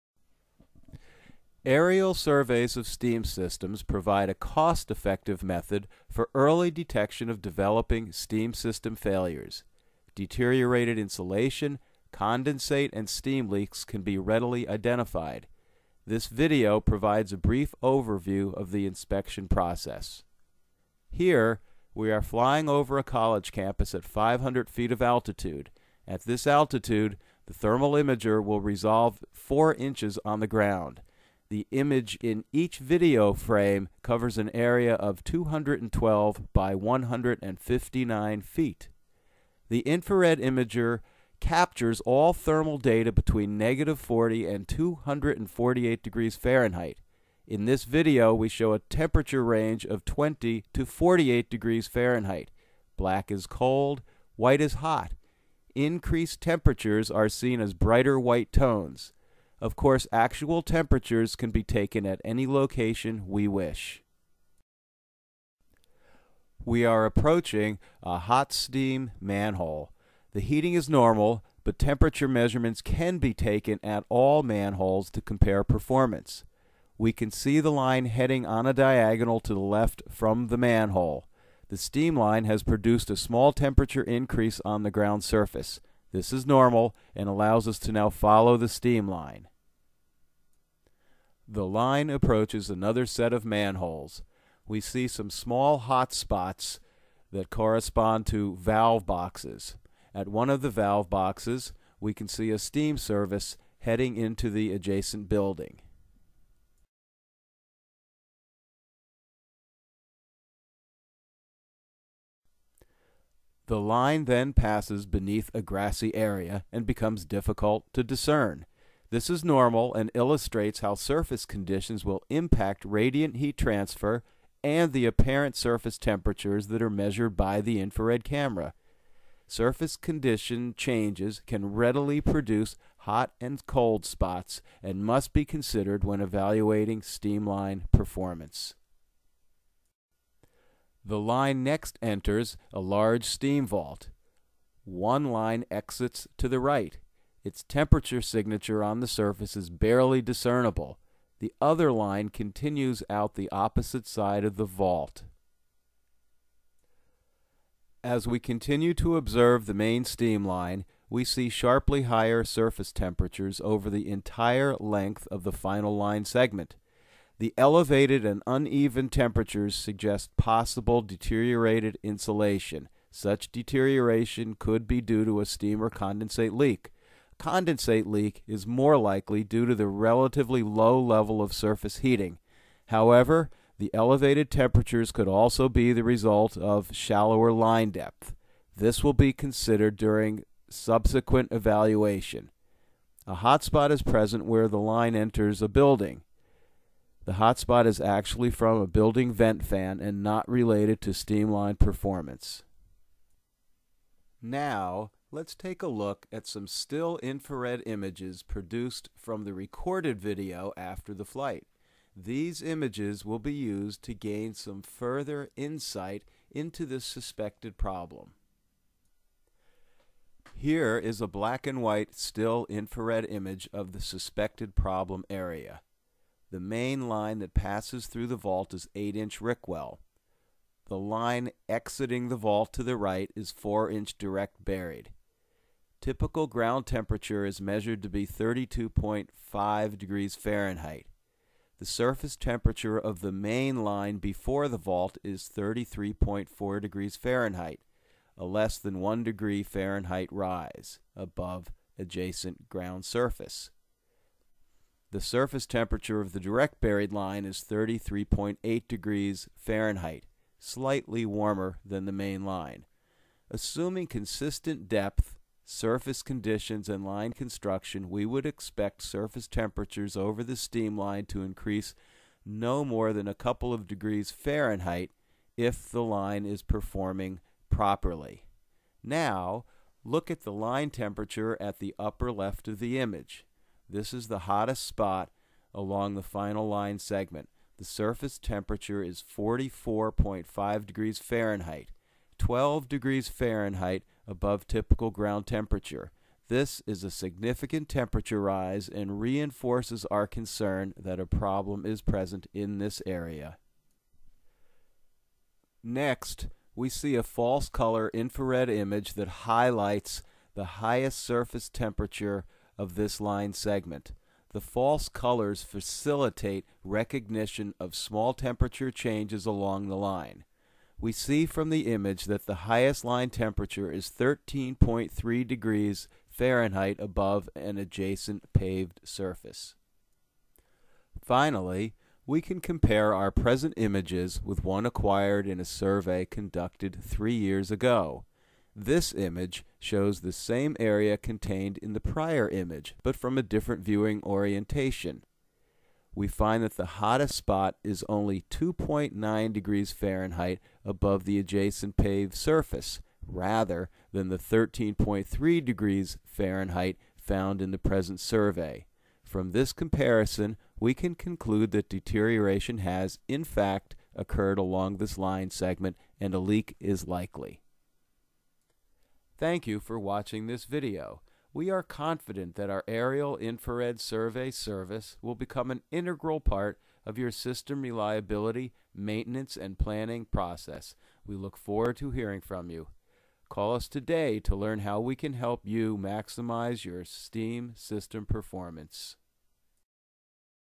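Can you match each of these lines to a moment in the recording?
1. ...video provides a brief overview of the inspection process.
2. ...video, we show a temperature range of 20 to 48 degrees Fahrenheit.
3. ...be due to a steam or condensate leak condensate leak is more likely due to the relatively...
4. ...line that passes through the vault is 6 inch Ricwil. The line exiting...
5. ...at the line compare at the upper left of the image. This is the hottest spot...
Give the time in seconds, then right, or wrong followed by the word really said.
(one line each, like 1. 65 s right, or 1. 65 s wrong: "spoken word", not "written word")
1. 16 s right
2. 47 s right
3. 174 s right
4. 227 s wrong: "8", not "6"
5. 280 s wrong: "temperature", not "compare".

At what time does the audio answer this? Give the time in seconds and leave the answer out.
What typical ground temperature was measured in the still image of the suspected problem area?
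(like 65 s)
238 s.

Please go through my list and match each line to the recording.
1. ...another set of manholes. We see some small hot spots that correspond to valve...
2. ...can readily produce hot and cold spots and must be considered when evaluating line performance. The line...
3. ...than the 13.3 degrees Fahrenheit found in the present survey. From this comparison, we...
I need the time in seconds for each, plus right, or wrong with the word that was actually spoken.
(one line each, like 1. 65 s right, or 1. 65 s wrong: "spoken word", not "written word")
1. 92 s right
2. 131 s right
3. 354 s right.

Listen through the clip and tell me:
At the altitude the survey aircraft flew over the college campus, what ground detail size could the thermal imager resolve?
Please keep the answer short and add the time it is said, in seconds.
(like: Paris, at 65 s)
4 inches, at 29 s.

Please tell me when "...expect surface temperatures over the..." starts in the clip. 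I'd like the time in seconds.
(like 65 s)
268 s.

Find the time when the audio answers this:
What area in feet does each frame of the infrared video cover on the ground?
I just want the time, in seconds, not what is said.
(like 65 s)
35 s.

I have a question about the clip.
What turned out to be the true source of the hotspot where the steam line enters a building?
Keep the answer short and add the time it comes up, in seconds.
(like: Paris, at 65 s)
a building vent fan, at 198 s.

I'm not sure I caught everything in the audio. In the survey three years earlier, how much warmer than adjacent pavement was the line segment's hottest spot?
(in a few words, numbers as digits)
2.9 degrees Fahrenheit.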